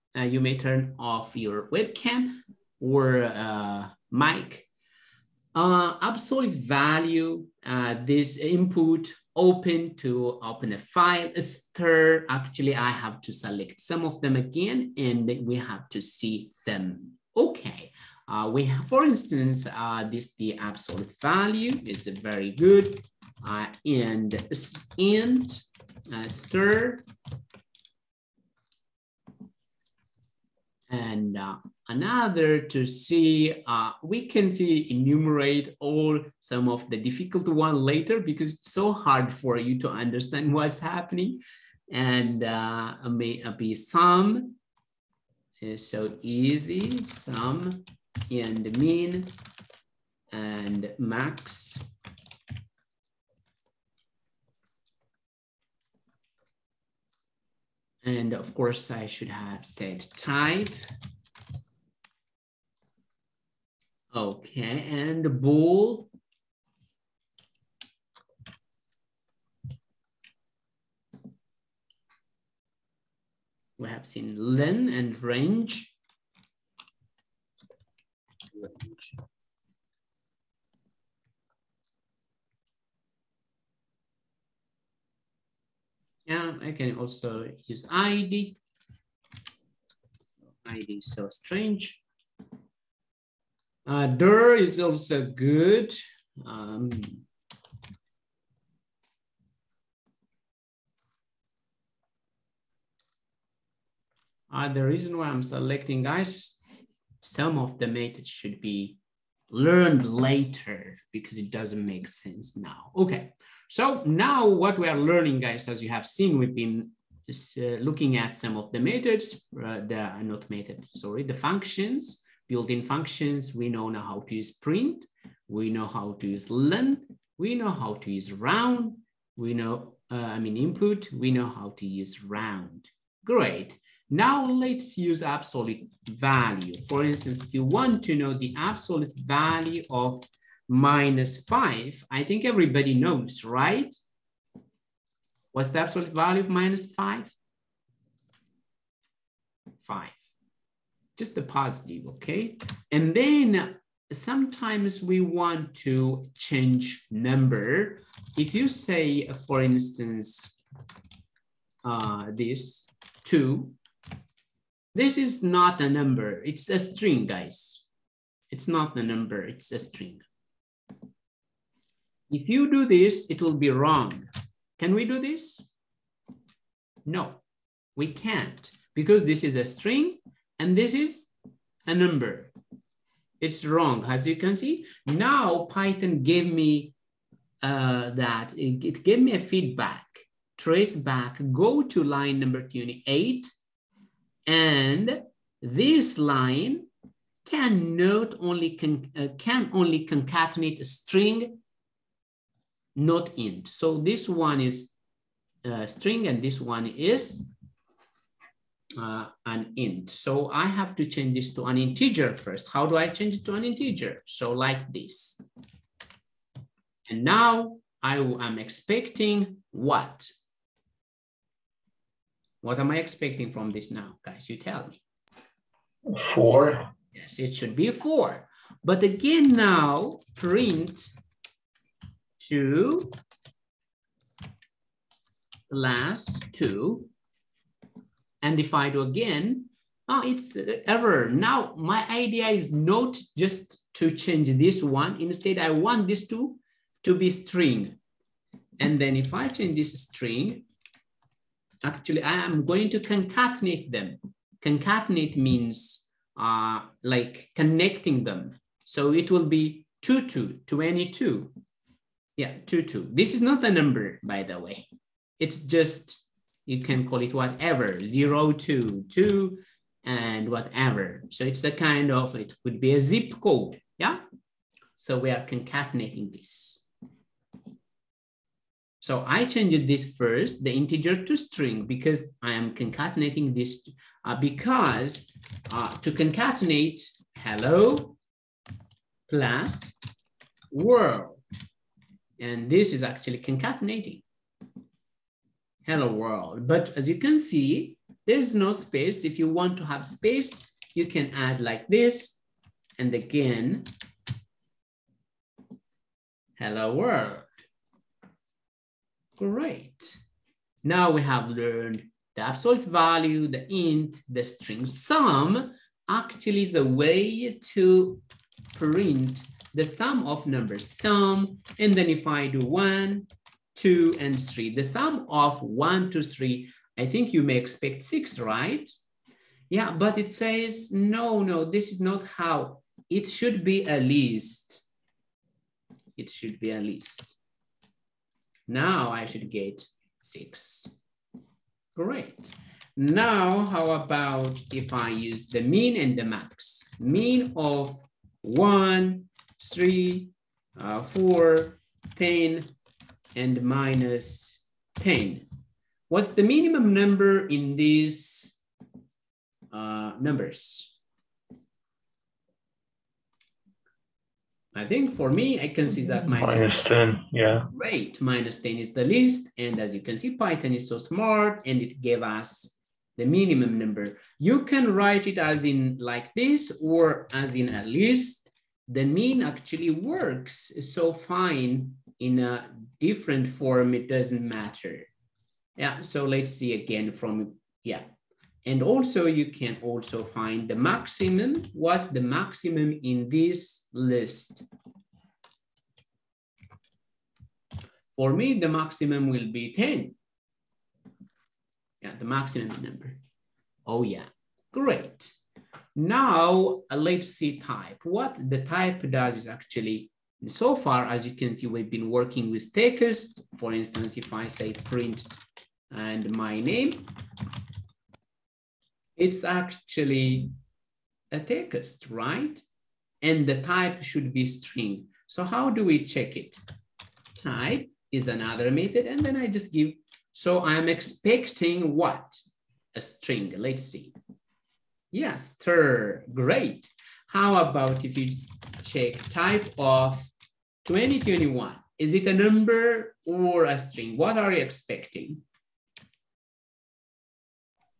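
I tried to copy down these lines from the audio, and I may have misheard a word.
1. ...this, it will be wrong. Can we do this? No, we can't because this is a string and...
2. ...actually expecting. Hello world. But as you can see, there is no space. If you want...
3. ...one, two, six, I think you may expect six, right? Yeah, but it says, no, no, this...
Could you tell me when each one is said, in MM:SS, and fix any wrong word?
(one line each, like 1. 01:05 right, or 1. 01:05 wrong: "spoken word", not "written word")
1. 02:52 right
2. 04:53 wrong: "concatenating", not "expecting"
3. 05:25 wrong: "three", not "six".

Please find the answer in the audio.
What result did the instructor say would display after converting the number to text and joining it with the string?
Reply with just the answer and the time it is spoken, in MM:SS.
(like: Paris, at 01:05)
22, at 04:20.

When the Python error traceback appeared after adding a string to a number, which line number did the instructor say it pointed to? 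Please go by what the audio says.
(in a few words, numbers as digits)
28.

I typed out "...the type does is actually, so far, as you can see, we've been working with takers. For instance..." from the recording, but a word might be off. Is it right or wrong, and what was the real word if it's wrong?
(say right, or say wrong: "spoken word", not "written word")
right.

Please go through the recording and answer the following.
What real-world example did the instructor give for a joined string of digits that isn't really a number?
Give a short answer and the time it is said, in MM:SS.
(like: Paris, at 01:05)
zip code, at 04:32.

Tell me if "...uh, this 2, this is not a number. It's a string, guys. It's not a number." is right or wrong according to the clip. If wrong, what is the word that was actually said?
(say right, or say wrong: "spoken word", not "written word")
right.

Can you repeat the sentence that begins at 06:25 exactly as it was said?
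Yeah, so let's see again from, yeah.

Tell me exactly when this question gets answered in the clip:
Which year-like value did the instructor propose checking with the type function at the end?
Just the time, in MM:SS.
07:20.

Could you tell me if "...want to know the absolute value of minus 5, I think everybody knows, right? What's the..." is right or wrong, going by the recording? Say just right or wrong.
right.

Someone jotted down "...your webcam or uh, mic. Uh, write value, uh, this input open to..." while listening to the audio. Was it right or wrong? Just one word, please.
wrong.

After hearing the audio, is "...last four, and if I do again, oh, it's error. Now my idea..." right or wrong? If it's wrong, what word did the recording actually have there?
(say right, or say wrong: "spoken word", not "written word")
wrong: "two", not "four".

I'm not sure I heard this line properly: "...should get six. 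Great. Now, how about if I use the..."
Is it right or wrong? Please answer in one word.
right.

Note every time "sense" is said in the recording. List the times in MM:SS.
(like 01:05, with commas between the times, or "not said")
01:52.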